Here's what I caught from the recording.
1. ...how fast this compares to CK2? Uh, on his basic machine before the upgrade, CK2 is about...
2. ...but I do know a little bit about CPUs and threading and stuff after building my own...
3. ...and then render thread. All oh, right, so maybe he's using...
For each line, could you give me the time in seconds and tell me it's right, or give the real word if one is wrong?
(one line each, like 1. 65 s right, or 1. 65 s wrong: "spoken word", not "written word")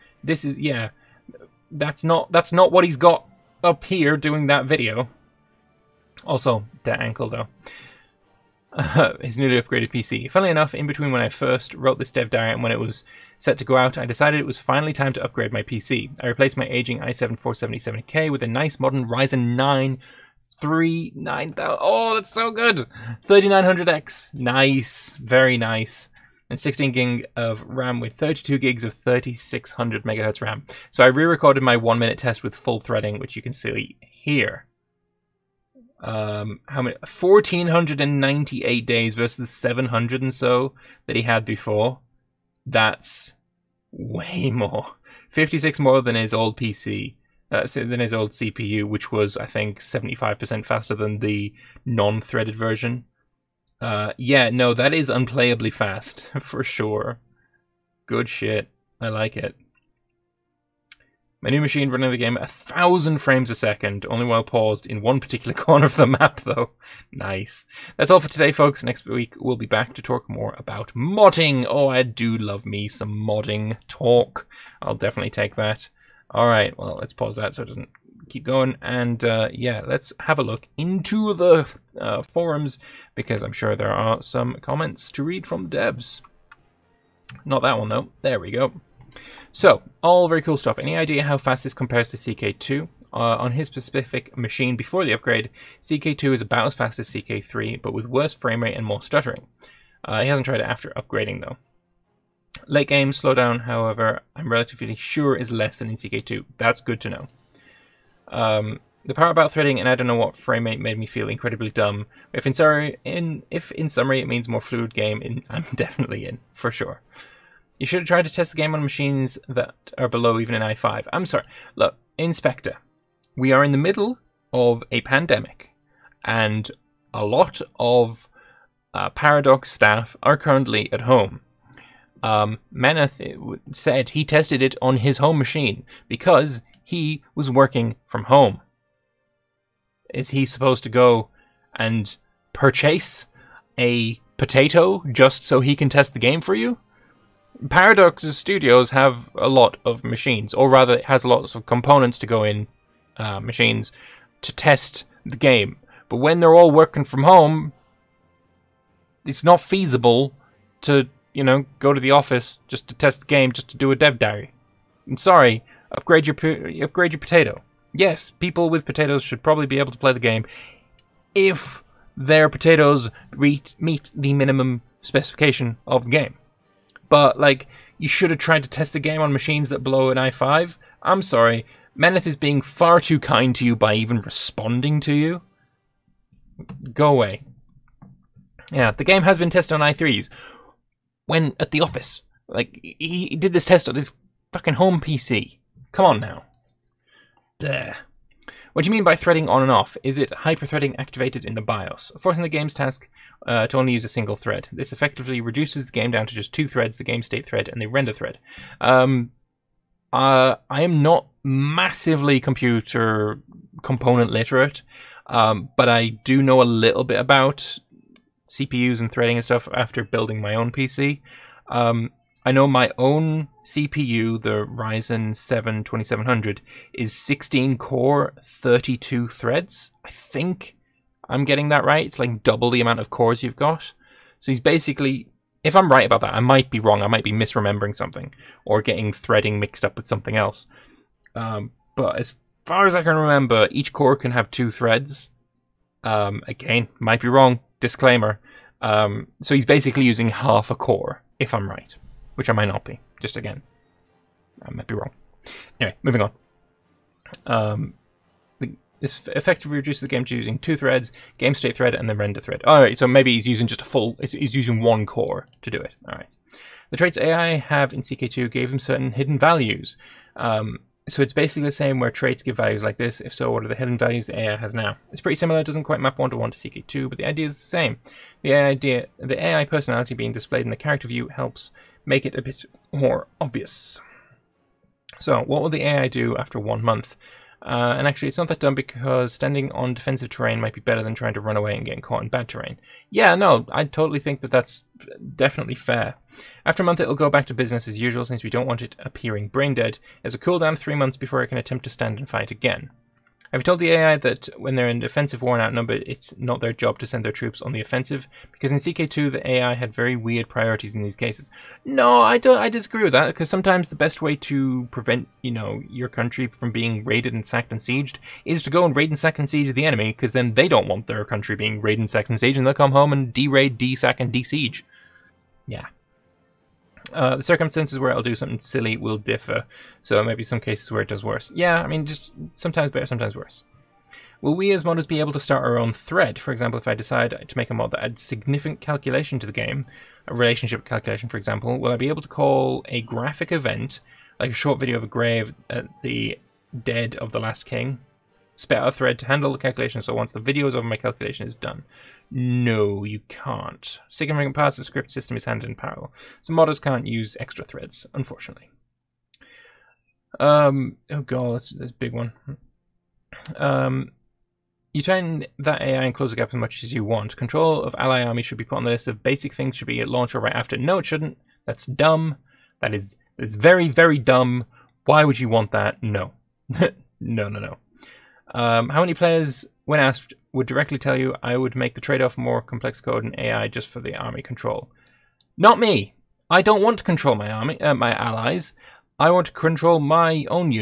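1. 91 s wrong: "specific", not "basic"
2. 215 s right
3. 261 s right.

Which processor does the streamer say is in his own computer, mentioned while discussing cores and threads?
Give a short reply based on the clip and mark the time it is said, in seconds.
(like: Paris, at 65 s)
Ryzen 7 2700, at 224 s.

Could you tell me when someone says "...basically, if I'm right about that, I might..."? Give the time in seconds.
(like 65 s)
234 s.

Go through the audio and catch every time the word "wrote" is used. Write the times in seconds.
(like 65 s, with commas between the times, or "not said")
11 s.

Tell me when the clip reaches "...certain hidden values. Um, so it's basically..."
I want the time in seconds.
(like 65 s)
268 s.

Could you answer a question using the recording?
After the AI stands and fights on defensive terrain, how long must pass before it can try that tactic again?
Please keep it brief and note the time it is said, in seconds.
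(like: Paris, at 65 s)
3 months, at 300 s.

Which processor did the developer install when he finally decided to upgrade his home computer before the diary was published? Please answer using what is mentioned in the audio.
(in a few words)
Ryzen 9 3900X.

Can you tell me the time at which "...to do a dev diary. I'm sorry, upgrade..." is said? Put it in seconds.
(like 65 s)
163 s.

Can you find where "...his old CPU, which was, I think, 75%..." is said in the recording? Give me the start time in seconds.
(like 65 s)
48 s.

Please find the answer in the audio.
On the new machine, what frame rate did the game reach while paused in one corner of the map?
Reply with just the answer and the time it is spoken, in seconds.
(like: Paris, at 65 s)
1000, at 62 s.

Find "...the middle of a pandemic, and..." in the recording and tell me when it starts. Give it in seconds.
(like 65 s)
123 s.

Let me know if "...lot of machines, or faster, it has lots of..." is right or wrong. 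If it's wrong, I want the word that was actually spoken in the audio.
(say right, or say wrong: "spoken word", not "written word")
wrong: "rather", not "faster".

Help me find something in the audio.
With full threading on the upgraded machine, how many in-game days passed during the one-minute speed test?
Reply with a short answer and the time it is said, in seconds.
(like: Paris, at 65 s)
1498, at 37 s.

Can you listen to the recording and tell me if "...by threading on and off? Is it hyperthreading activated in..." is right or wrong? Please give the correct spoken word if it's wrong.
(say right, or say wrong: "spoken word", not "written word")
right.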